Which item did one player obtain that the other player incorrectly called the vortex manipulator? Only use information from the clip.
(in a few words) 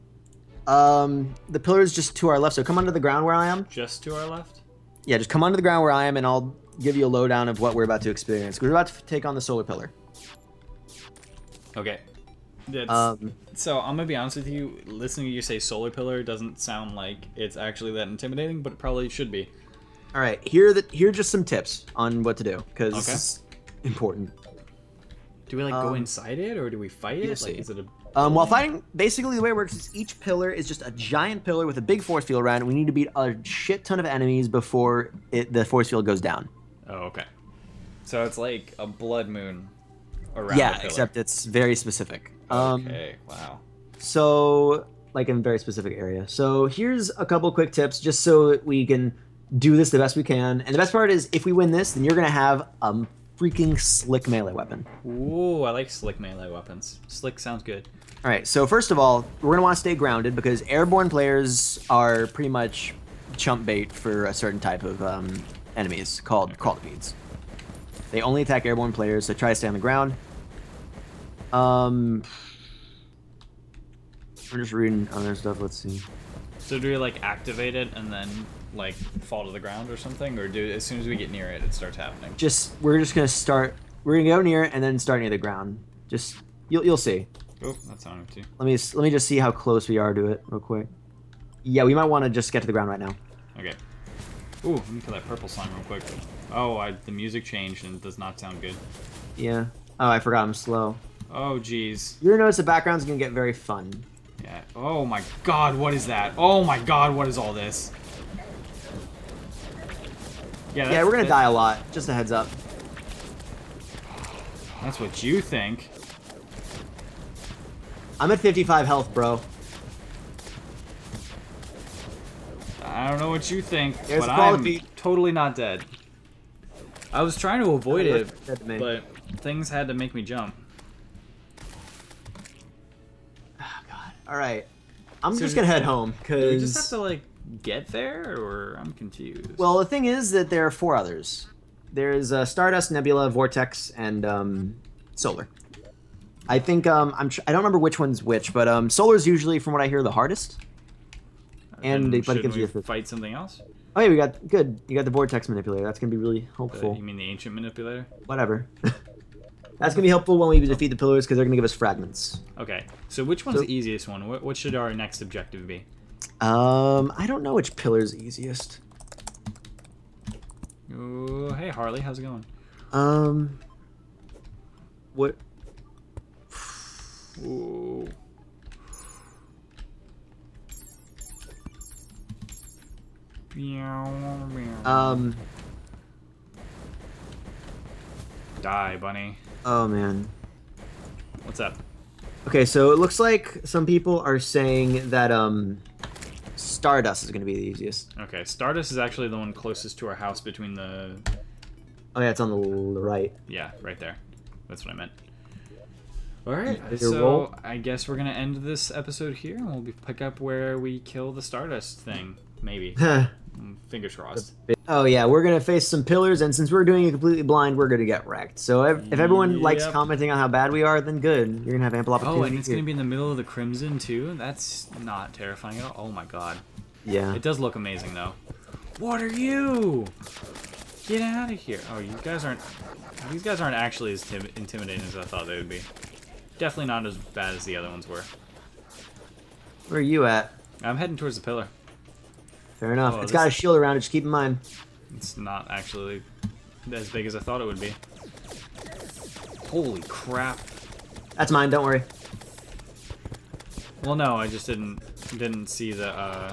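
Ancient manipulator.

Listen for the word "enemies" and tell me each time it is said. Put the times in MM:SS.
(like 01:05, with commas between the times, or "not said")
00:34, 01:05.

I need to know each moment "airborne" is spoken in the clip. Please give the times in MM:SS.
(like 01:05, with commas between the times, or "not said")
01:00, 01:08.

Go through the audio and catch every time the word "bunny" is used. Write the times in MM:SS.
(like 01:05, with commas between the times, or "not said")
03:08.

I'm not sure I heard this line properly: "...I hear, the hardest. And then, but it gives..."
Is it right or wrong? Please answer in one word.
right.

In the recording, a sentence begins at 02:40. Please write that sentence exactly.
defeat the pillars because they're gonna give us fragments.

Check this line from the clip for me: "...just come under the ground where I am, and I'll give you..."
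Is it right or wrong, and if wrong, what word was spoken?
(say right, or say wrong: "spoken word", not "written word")
right.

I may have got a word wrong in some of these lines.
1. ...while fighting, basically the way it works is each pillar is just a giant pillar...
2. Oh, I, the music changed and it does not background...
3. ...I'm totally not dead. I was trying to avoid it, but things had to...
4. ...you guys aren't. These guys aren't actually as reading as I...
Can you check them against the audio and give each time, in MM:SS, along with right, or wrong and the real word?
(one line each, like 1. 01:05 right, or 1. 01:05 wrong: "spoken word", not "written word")
1. 00:28 right
2. 01:36 wrong: "sound", not "background"
3. 02:04 right
4. 03:51 wrong: "intimidating", not "reading".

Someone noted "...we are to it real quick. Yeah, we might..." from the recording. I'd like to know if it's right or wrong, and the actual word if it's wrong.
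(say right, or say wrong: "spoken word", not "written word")
right.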